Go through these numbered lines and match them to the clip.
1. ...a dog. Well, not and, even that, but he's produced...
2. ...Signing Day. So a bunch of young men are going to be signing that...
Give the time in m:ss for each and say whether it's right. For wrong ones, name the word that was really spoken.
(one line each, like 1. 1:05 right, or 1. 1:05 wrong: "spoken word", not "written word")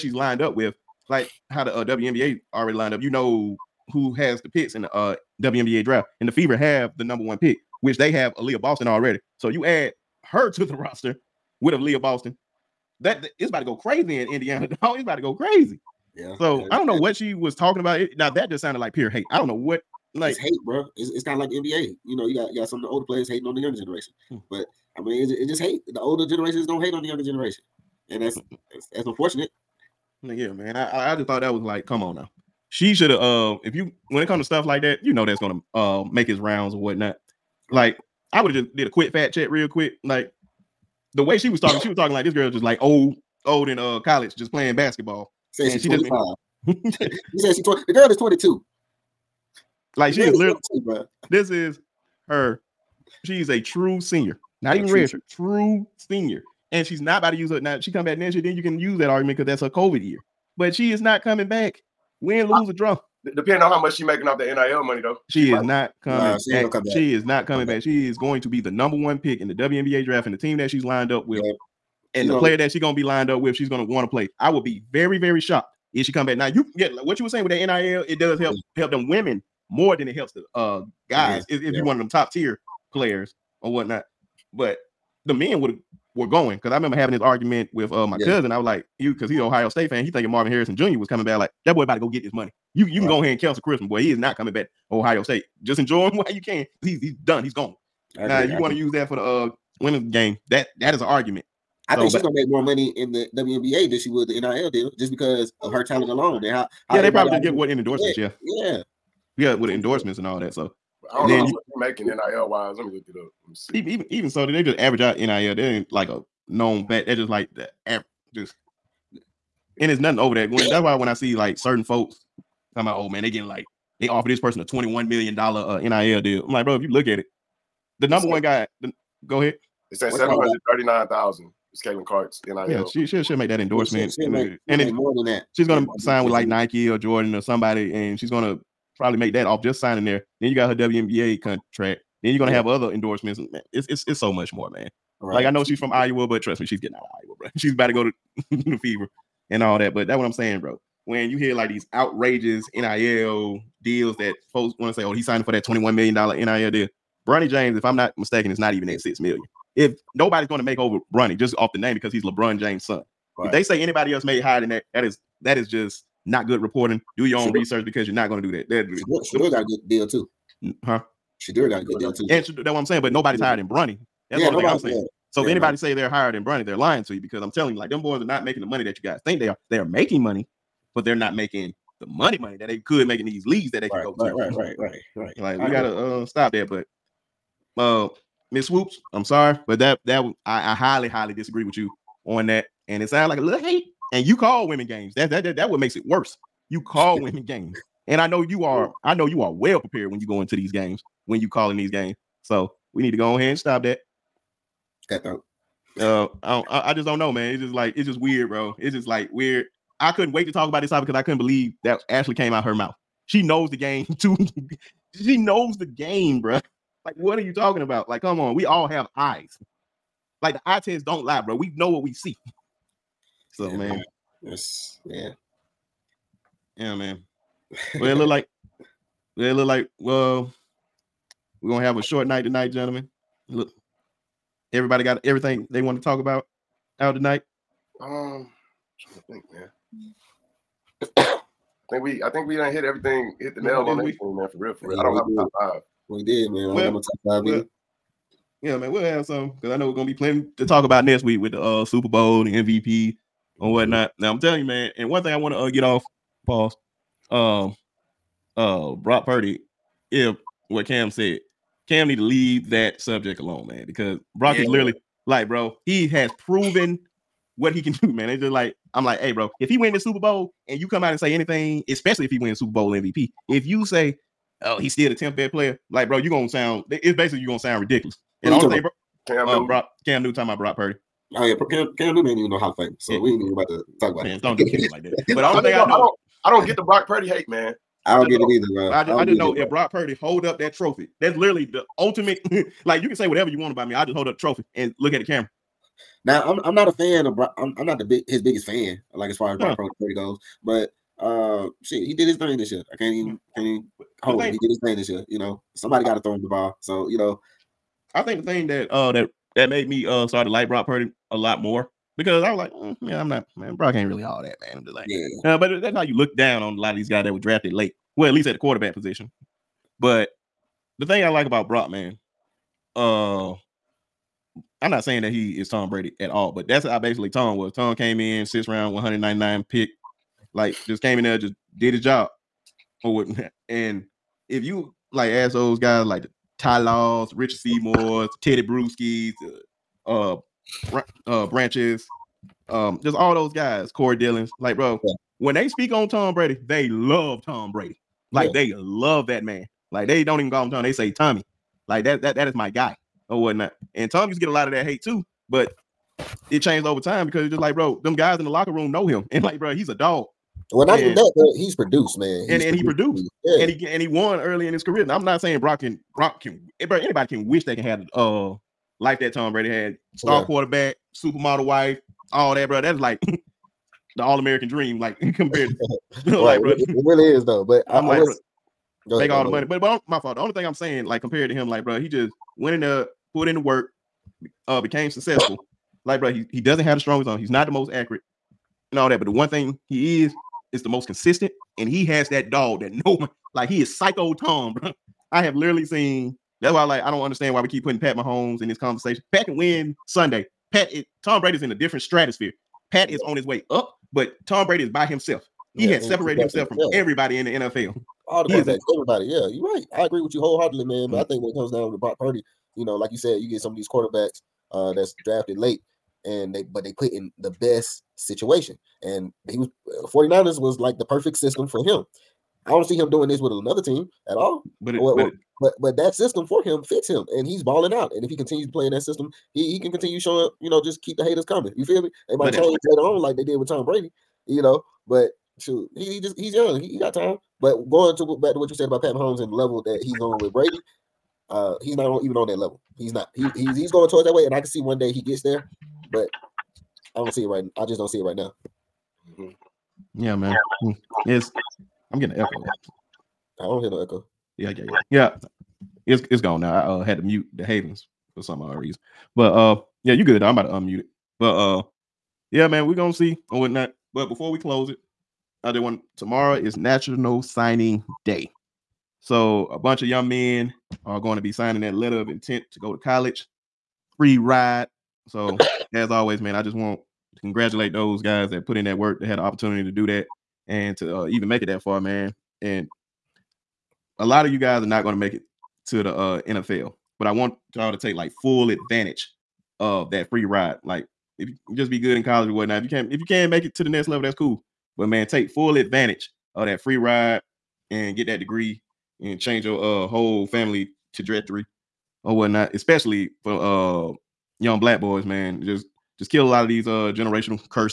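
1. 5:59 right
2. 7:47 right.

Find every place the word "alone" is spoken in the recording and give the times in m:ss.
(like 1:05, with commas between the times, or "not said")
1:46, 4:23.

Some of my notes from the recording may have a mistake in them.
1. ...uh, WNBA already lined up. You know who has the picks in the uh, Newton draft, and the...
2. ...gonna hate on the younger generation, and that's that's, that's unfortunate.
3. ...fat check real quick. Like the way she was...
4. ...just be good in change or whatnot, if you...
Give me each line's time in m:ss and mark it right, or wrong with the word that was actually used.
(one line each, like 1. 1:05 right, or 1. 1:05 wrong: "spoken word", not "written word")
1. 0:01 wrong: "WNBA", not "Newton"
2. 0:26 right
3. 0:39 right
4. 8:11 wrong: "college", not "change".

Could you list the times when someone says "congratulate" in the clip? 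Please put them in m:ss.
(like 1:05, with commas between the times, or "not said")
7:57.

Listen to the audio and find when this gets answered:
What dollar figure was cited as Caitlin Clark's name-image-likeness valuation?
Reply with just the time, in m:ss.
2:10.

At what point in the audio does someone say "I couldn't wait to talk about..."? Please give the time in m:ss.
3:29.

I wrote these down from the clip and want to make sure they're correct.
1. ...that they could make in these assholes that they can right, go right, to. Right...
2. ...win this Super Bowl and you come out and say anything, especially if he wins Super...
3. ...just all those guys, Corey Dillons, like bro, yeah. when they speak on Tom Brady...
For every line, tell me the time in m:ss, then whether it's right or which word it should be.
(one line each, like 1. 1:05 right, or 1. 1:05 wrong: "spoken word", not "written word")
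1. 3:02 wrong: "leagues", not "assholes"
2. 4:29 right
3. 5:43 right.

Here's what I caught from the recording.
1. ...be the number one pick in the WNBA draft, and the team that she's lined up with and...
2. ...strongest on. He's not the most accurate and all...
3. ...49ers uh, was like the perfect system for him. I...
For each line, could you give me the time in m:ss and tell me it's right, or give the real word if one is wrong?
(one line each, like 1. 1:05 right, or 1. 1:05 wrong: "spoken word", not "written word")
1. 1:08 right
2. 6:26 right
3. 7:00 right.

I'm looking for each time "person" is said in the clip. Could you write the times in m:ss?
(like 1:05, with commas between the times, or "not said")
2:04.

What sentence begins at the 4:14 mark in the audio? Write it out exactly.
Now I'm telling you, man, and one thing I want to uh, get off, pause.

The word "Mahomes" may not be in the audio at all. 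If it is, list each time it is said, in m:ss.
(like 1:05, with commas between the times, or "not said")
6:38, 7:19.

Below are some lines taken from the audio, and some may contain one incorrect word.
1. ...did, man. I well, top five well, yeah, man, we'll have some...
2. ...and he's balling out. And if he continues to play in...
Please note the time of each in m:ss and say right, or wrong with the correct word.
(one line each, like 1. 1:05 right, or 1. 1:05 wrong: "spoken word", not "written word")
1. 4:06 right
2. 7:07 right.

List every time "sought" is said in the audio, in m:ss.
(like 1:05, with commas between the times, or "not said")
not said.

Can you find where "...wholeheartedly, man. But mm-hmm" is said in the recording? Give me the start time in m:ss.
6:50.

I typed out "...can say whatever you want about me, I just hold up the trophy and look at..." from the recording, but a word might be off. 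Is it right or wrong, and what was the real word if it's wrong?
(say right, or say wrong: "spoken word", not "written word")
right.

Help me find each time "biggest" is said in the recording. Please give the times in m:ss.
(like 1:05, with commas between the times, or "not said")
4:58.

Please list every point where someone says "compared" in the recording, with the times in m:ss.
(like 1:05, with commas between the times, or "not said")
6:15, 6:21.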